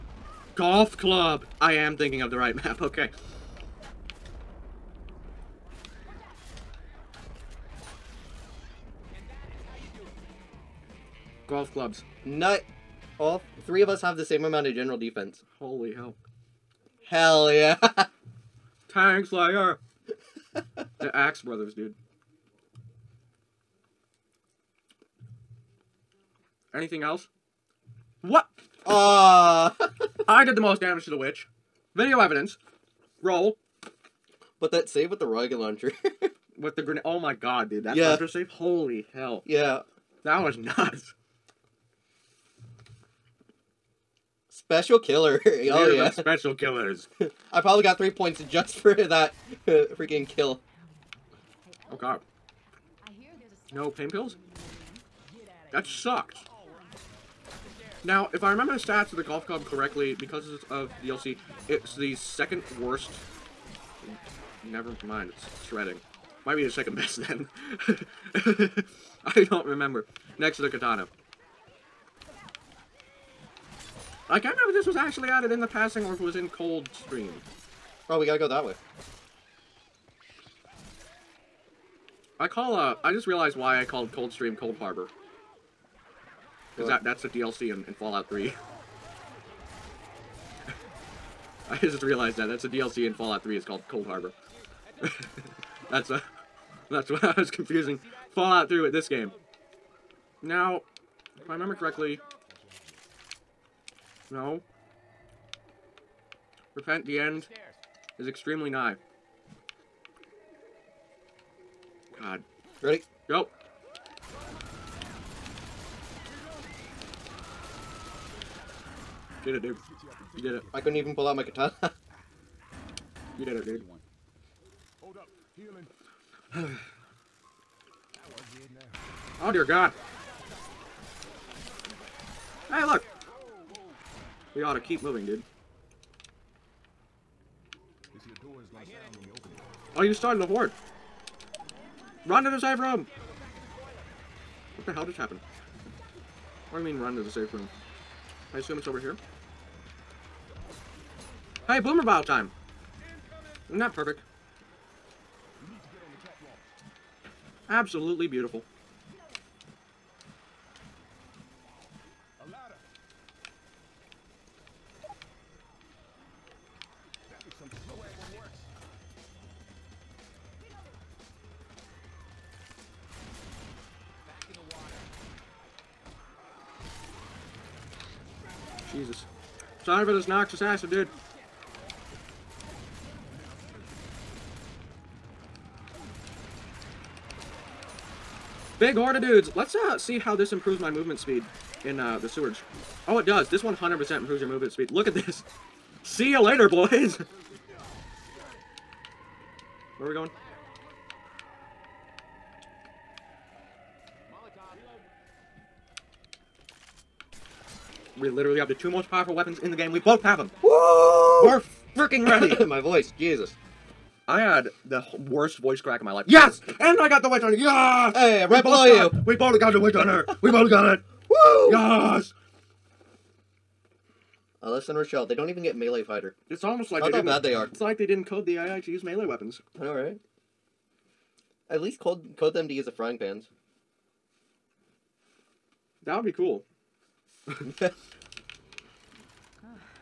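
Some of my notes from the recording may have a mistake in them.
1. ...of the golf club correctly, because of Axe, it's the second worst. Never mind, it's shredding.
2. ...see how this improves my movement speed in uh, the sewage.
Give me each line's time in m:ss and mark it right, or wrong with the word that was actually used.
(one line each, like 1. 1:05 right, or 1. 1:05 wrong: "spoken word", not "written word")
1. 0:59 wrong: "DLC", not "Axe"
2. 3:09 right.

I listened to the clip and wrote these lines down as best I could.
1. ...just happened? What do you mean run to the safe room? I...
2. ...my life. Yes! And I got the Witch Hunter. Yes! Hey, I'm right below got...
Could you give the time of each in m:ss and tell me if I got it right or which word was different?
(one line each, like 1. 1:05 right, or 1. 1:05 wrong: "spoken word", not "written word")
1. 2:25 right
2. 3:36 right.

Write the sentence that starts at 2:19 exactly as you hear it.
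Are oh, you starting a horde?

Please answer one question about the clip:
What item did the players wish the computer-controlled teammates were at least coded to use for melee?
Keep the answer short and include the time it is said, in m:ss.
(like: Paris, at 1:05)
Frying pans, at 3:52.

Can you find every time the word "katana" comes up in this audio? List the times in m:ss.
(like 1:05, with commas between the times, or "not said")
1:10, 2:01.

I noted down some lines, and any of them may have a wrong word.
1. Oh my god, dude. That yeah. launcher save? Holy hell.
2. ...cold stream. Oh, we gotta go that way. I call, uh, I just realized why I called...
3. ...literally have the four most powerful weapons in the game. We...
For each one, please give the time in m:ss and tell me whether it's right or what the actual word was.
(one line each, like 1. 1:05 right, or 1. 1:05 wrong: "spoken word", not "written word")
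1. 0:37 right
2. 1:16 right
3. 3:28 wrong: "two", not "four".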